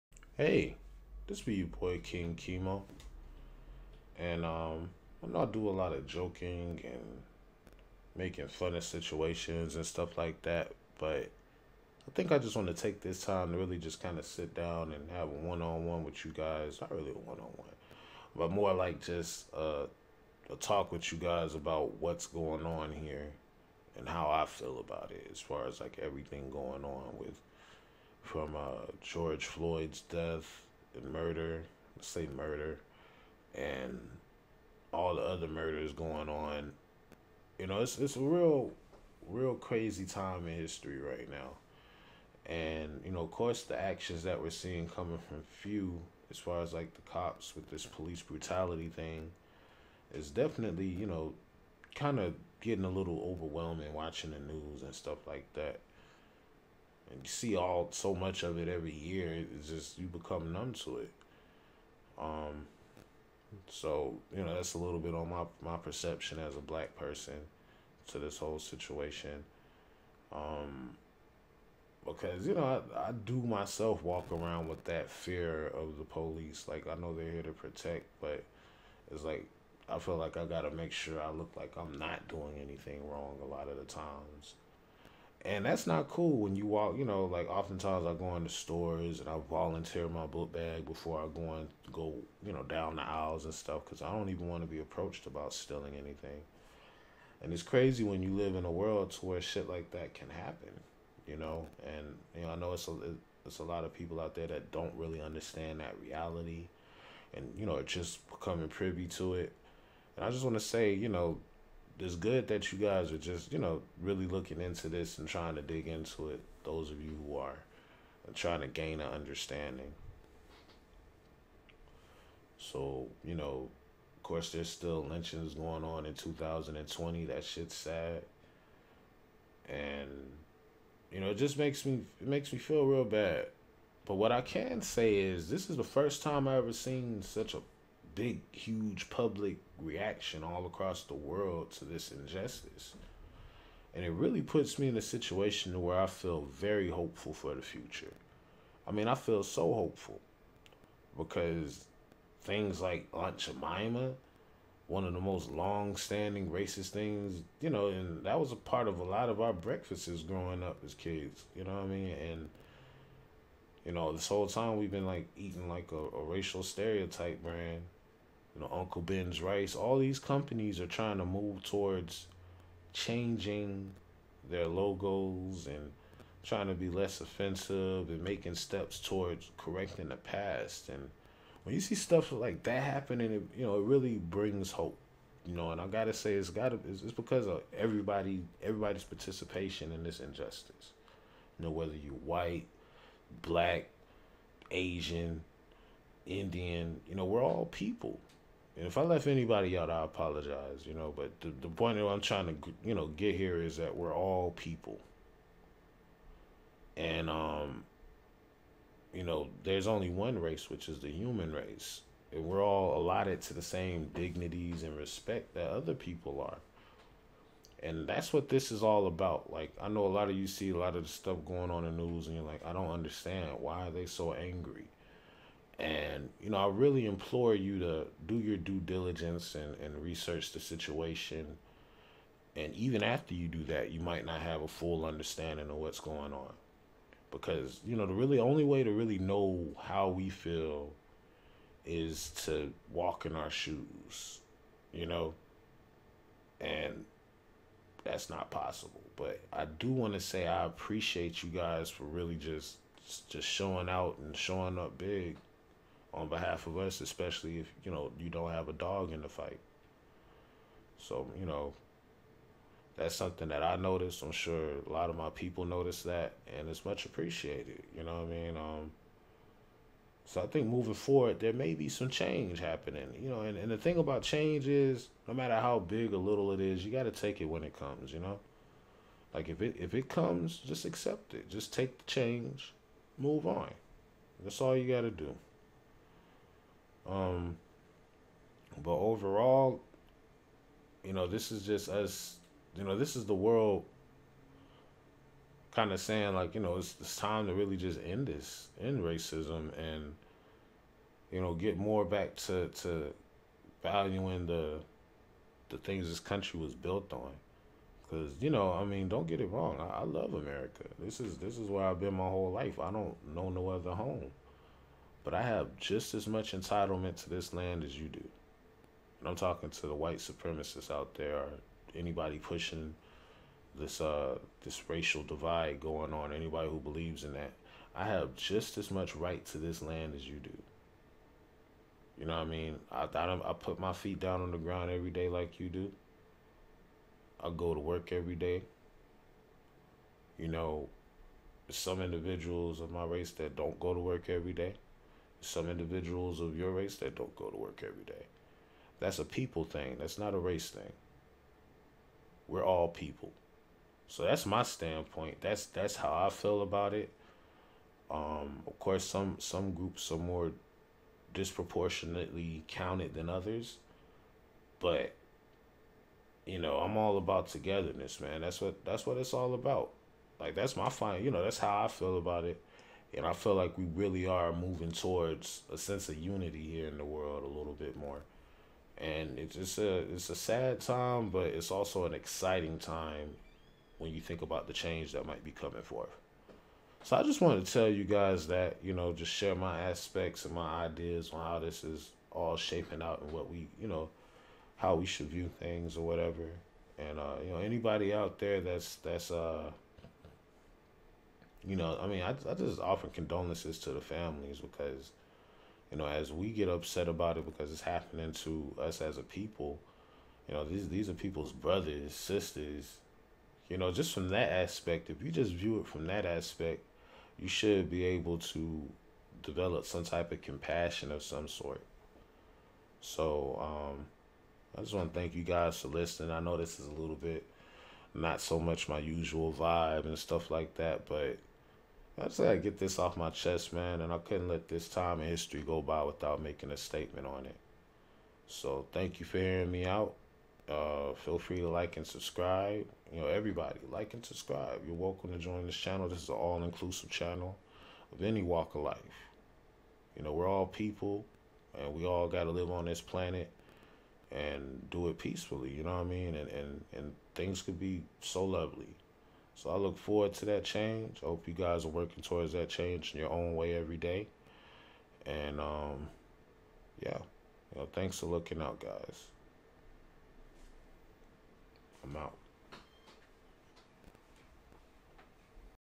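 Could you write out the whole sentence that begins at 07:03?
So, um, I just want to thank you guys for listening.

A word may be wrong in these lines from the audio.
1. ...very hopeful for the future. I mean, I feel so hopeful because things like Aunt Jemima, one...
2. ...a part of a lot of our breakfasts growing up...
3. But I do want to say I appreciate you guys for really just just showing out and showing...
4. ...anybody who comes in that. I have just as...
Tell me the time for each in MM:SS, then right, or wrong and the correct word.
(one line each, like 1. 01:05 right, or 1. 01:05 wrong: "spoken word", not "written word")
1. 02:26 right
2. 02:38 right
3. 04:09 right
4. 05:26 wrong: "believes", not "comes".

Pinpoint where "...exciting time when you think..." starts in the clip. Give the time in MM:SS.
06:22.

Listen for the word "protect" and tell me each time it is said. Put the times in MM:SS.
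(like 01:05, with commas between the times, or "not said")
01:17.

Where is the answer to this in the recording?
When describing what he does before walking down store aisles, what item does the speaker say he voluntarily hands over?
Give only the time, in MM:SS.
01:30.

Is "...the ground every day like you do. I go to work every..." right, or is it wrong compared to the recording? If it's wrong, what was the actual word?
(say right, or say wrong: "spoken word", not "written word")
right.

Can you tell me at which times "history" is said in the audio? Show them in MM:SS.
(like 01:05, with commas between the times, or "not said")
00:40, 07:15.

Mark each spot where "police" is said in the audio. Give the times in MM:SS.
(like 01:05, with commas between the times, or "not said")
00:47, 01:16.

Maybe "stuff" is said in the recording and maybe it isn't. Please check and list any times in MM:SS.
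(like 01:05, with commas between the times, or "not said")
00:09, 00:54, 01:33, 03:01, 03:41, 07:10.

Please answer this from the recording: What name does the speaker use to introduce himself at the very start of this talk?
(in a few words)
King Chemo.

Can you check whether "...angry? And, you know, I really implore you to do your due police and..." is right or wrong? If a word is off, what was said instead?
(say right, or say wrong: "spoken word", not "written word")
wrong: "diligence", not "police".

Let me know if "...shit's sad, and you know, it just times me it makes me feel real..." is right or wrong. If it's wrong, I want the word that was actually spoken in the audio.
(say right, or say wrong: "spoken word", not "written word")
wrong: "makes", not "times".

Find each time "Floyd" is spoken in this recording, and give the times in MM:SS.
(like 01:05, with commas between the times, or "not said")
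00:29.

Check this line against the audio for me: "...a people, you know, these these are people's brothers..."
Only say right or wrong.
right.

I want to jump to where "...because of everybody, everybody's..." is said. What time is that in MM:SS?
03:07.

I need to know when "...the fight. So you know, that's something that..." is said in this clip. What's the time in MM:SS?
04:19.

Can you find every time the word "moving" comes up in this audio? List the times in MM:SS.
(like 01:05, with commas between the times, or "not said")
04:30, 06:14.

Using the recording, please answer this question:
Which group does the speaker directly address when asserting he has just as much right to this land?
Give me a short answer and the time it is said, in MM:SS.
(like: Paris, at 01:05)
white supremacists, at 05:19.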